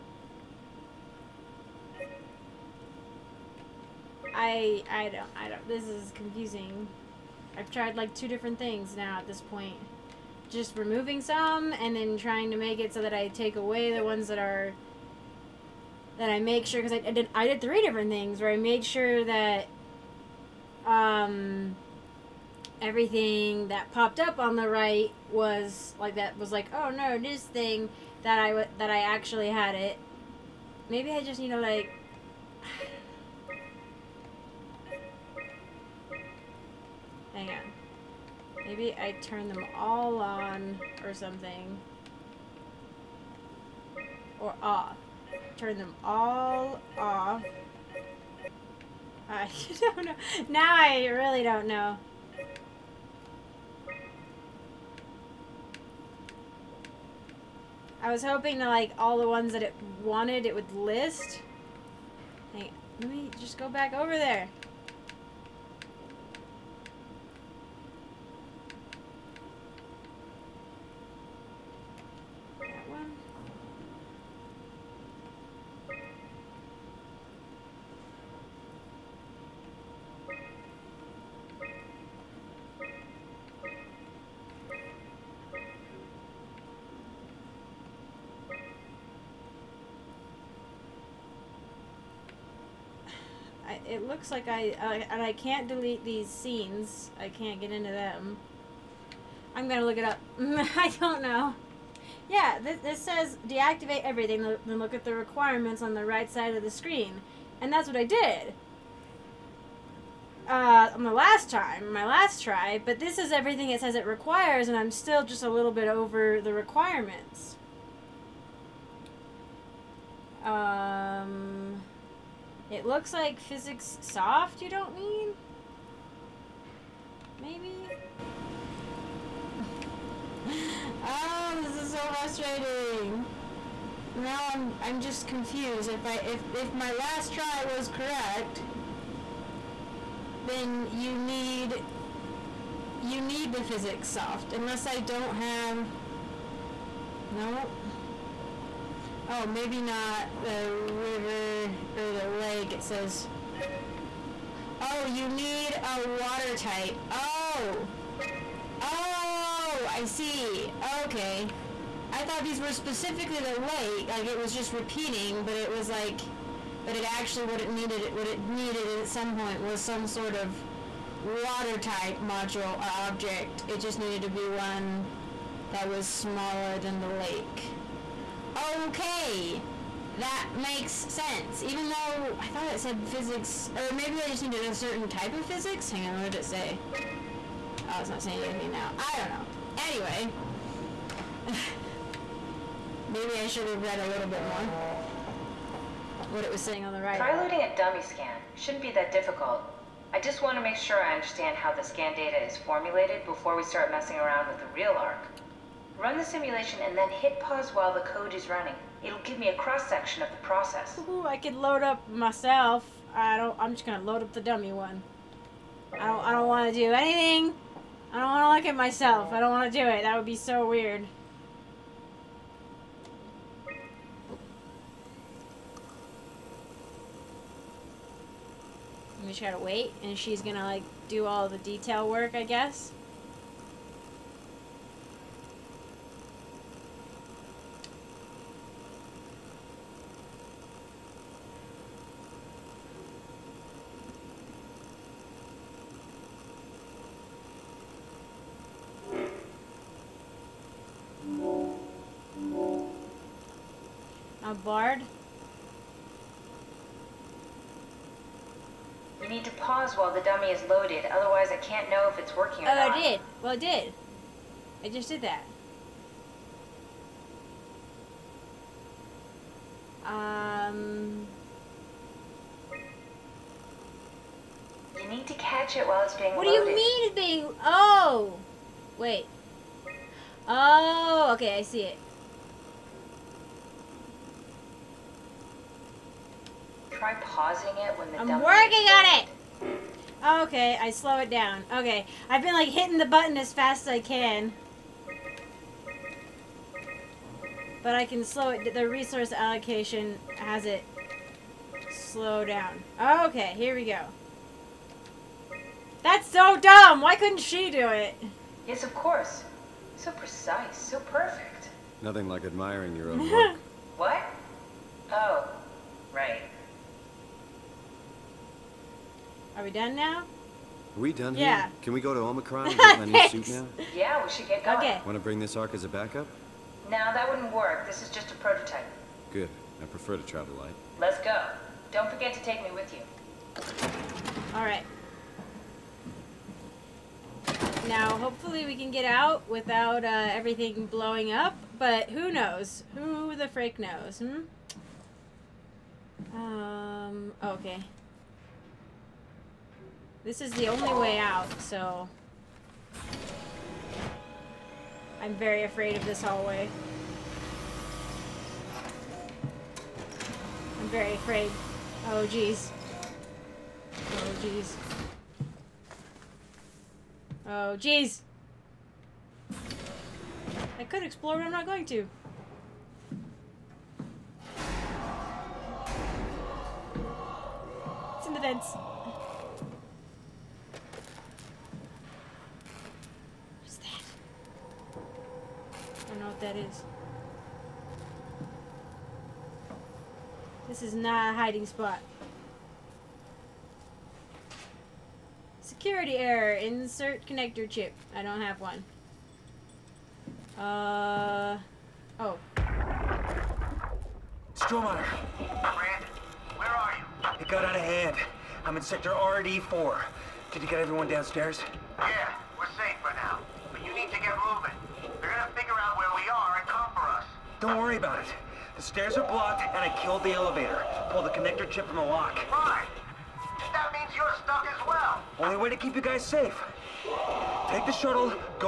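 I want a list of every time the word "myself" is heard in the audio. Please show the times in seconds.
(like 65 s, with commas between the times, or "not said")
212 s, 218 s.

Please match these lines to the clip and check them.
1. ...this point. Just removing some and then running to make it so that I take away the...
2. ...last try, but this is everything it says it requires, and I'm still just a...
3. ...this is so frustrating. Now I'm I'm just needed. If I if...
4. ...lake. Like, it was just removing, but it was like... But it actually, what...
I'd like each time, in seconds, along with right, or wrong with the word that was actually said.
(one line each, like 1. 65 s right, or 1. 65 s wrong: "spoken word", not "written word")
1. 9 s wrong: "trying", not "running"
2. 112 s right
3. 131 s wrong: "confused", not "needed"
4. 163 s wrong: "repeating", not "removing".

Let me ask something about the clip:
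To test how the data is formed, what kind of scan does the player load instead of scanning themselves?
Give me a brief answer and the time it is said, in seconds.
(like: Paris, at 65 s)
dummy scan, at 197 s.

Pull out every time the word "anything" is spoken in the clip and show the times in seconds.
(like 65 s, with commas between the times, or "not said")
188 s, 216 s.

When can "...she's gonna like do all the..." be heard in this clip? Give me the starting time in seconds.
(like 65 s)
230 s.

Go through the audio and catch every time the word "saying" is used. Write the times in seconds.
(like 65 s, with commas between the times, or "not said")
188 s, 196 s.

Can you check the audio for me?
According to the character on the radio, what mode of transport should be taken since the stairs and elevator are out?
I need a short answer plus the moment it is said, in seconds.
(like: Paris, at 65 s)
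the shuttle, at 427 s.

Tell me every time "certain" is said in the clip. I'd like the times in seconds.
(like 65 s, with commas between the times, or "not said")
184 s.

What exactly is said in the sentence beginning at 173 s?
It just needed to be one that was smaller than the lake.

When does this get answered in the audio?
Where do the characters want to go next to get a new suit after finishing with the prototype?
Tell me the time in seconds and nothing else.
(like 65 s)
322 s.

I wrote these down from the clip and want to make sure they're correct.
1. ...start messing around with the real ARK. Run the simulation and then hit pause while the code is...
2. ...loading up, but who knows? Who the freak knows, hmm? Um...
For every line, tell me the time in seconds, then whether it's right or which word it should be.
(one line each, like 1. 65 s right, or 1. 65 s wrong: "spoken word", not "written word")
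1. 203 s right
2. 340 s wrong: "blowing", not "loading".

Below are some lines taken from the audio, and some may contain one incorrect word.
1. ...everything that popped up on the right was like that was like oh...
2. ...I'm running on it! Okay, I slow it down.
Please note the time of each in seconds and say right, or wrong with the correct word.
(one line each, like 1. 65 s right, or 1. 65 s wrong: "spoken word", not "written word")
1. 22 s right
2. 288 s wrong: "working", not "running".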